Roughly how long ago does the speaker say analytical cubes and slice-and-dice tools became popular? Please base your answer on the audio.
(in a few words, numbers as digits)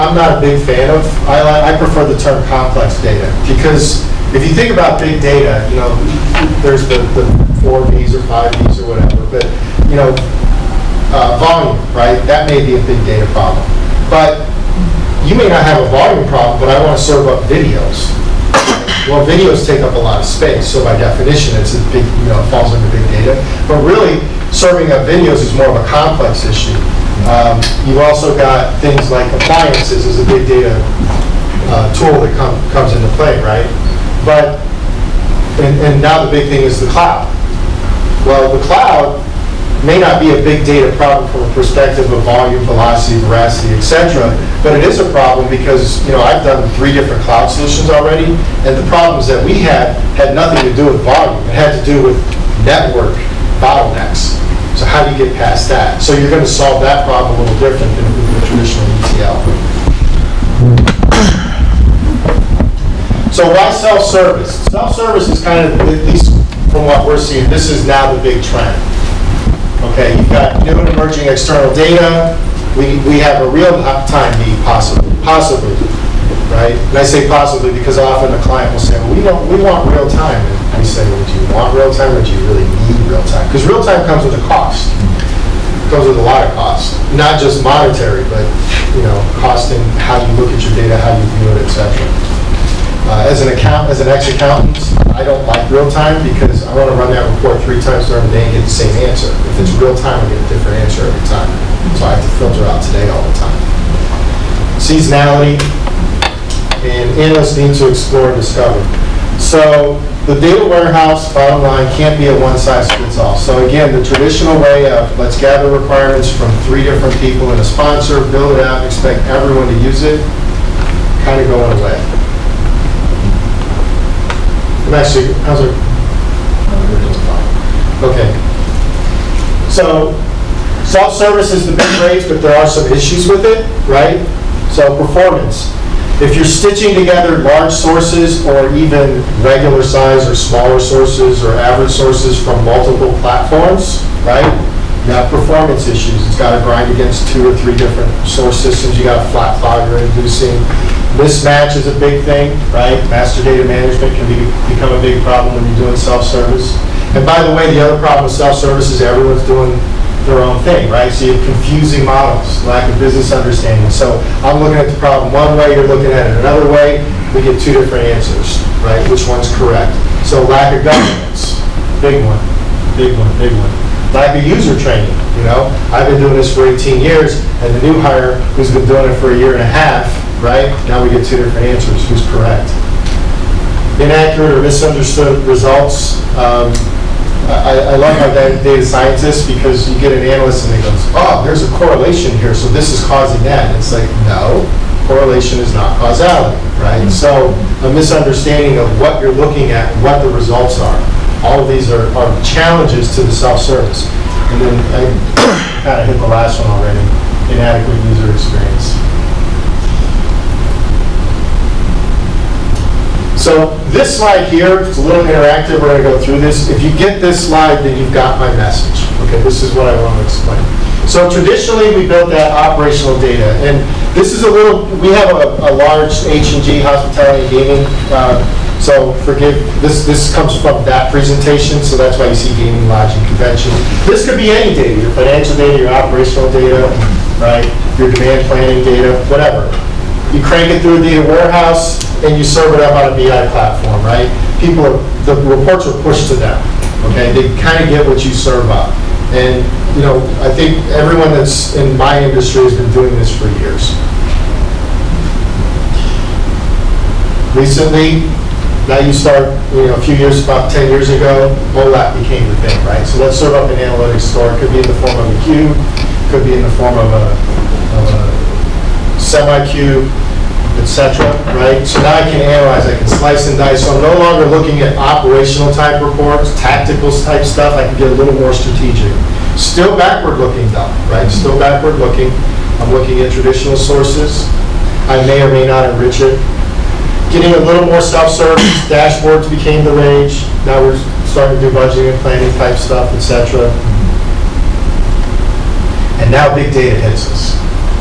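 10 years ago.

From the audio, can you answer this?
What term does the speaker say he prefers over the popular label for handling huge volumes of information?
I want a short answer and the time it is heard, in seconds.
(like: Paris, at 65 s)
complex data, at 2 s.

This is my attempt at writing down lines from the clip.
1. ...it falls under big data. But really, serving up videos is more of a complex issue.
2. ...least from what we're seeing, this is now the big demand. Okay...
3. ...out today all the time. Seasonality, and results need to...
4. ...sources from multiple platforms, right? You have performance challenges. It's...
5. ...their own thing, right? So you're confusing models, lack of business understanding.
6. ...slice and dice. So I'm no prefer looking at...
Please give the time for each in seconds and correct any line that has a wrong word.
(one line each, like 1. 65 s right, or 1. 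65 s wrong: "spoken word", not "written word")
1. 22 s right
2. 66 s wrong: "trend", not "demand"
3. 102 s wrong: "analysts", not "results"
4. 141 s wrong: "issues", not "challenges"
5. 160 s right
6. 273 s wrong: "longer", not "prefer".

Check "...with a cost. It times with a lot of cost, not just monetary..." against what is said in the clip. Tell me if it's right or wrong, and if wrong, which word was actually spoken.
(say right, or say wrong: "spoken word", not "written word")
wrong: "comes", not "times".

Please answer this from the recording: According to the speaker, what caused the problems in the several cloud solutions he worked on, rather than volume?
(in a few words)
network bottlenecks.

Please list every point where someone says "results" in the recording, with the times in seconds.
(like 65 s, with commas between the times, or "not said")
185 s, 200 s.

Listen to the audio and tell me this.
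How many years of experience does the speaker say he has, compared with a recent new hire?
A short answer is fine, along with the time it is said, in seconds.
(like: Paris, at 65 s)
18, at 176 s.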